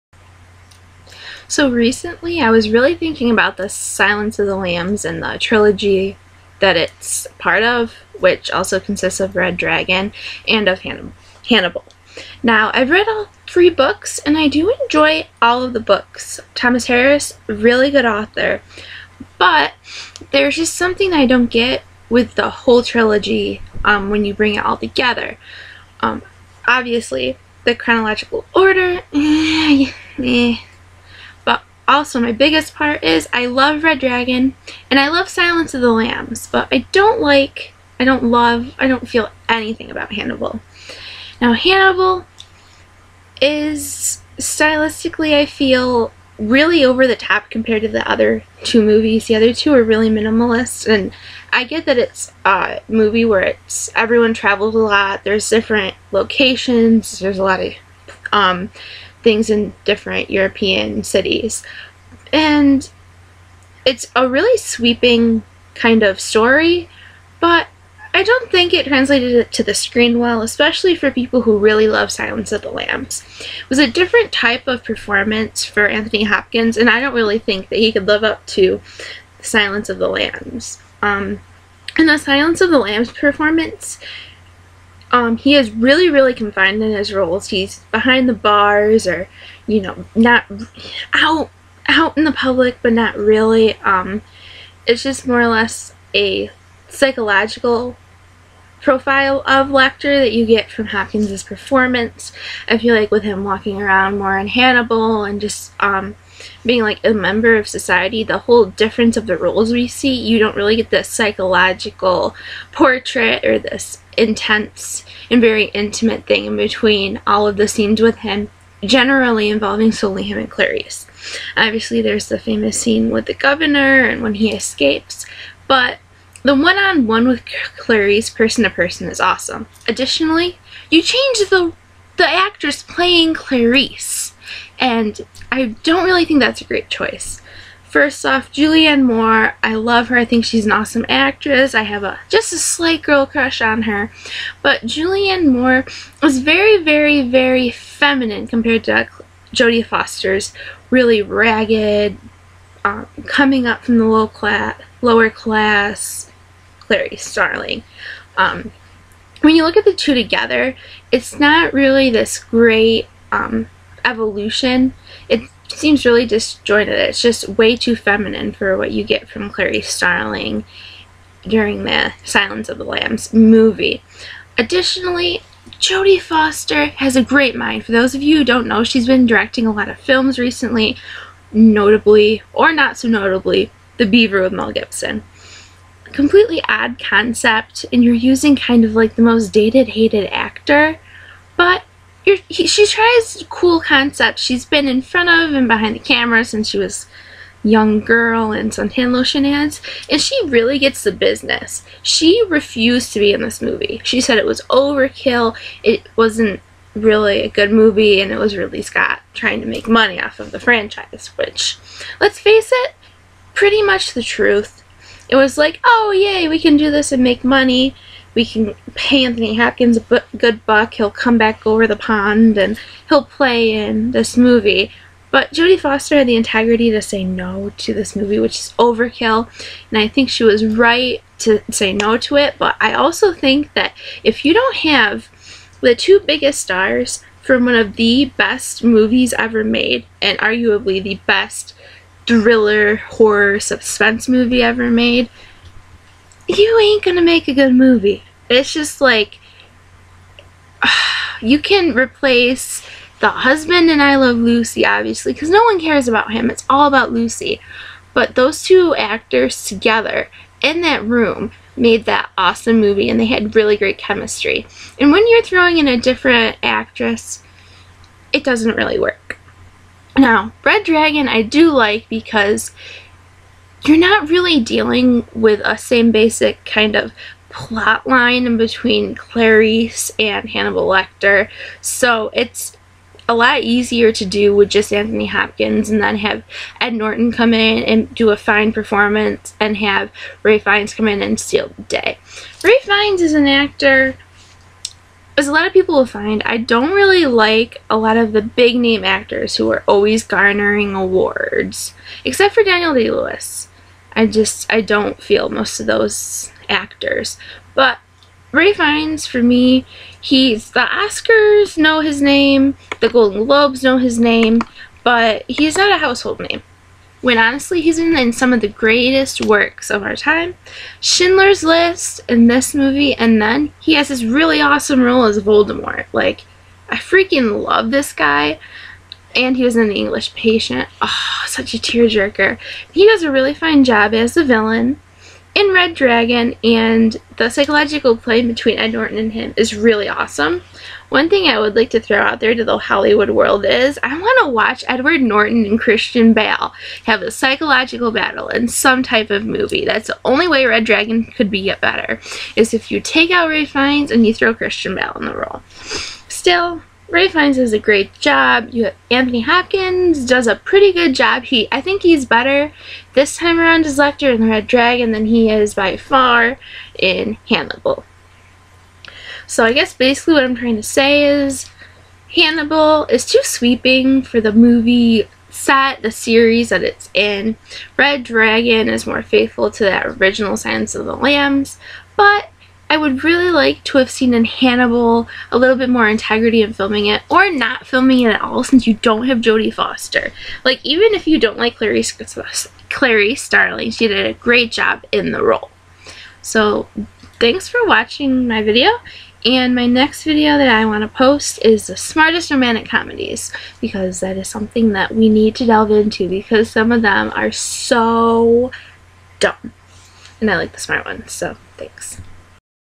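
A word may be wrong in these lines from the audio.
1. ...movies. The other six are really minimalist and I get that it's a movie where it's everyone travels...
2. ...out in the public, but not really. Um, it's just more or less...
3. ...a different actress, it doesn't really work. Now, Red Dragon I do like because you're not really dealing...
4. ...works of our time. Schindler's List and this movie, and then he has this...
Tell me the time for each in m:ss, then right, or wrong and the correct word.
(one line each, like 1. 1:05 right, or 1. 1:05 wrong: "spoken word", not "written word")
1. 0:48 wrong: "two", not "six"
2. 1:31 right
3. 4:25 right
4. 5:19 right.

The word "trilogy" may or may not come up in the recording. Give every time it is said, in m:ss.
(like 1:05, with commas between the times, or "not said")
0:05, 0:22.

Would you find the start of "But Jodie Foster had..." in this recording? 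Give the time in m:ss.
3:45.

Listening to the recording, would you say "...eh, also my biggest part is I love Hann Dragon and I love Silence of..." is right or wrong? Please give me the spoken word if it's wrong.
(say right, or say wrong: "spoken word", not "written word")
wrong: "Red", not "Hann".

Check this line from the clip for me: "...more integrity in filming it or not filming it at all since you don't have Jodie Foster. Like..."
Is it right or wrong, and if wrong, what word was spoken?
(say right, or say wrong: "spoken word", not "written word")
right.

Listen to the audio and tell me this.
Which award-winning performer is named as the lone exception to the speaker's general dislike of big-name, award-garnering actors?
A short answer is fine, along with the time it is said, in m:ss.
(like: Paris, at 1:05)
Daniel Day Lewis, at 5:02.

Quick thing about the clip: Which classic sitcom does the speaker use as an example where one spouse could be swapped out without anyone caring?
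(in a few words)
I Love Lucy.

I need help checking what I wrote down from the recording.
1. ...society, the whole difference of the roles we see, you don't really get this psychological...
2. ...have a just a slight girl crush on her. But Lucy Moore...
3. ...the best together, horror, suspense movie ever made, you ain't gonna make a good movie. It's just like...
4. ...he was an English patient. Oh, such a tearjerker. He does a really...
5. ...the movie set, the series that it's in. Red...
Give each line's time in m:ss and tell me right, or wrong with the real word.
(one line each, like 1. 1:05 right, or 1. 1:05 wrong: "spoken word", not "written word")
1. 1:47 right
2. 2:21 wrong: "Julianne", not "Lucy"
3. 4:01 wrong: "thriller", not "together"
4. 5:29 right
5. 6:14 right.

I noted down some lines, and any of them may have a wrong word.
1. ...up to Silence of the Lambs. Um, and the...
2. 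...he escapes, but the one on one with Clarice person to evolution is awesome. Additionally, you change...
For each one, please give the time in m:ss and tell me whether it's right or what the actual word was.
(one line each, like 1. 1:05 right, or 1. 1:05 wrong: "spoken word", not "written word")
1. 1:18 right
2. 2:04 wrong: "person", not "evolution".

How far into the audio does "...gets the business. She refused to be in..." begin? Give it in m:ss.
3:20.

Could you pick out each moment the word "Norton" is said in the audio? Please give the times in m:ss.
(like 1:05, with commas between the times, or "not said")
4:46, 5:38, 5:45.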